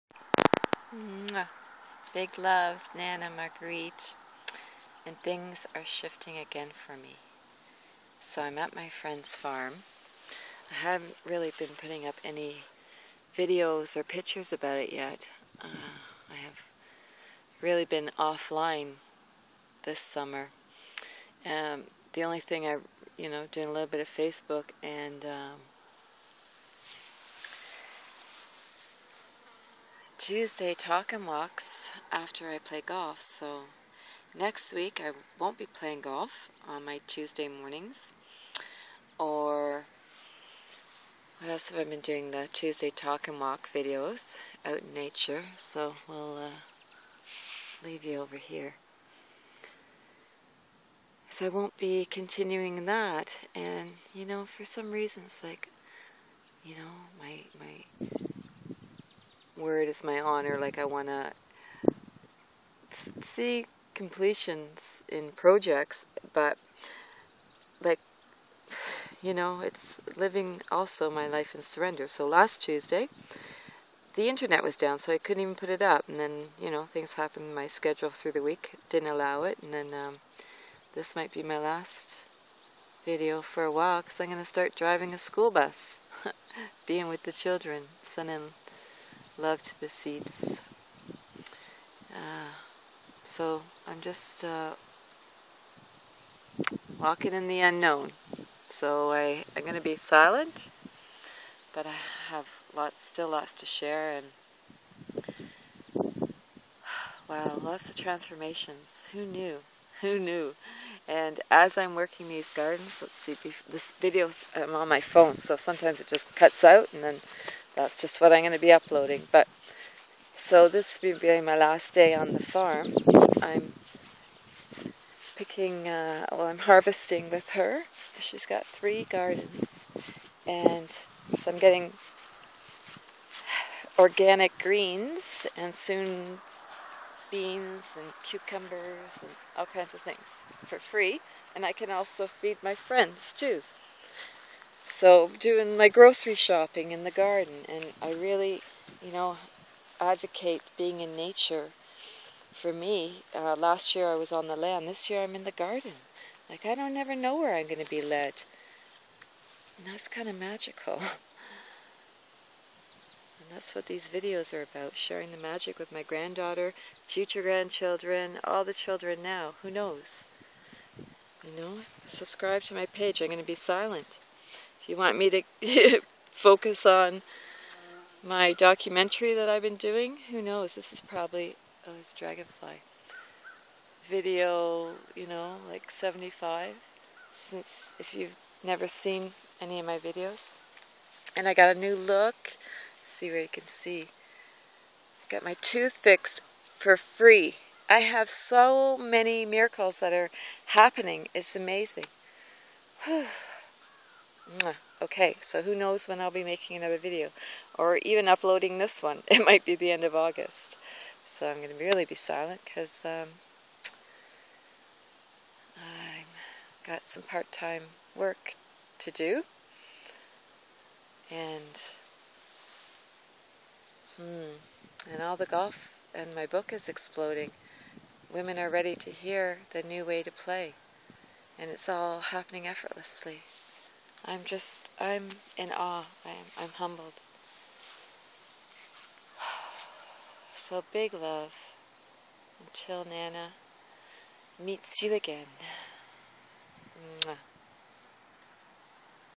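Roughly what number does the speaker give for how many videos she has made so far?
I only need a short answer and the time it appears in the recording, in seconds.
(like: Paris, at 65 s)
75, at 185 s.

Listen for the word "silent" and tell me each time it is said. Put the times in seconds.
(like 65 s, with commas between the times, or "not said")
99 s, 173 s, 212 s.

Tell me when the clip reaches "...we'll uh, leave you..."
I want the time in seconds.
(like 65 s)
46 s.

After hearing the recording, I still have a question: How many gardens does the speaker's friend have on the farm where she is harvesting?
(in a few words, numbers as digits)
3.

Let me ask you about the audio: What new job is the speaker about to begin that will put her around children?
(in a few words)
Driving a school bus.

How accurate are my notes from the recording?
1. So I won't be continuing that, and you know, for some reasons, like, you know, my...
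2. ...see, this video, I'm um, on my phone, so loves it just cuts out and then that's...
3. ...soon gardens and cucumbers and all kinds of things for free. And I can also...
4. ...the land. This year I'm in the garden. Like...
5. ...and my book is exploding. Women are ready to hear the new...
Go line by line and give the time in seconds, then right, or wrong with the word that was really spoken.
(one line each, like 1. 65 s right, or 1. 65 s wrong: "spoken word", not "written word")
1. 51 s right
2. 113 s wrong: "sometimes", not "loves"
3. 135 s wrong: "beans", not "gardens"
4. 154 s right
5. 226 s right.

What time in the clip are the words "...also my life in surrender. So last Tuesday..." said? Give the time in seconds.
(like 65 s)
70 s.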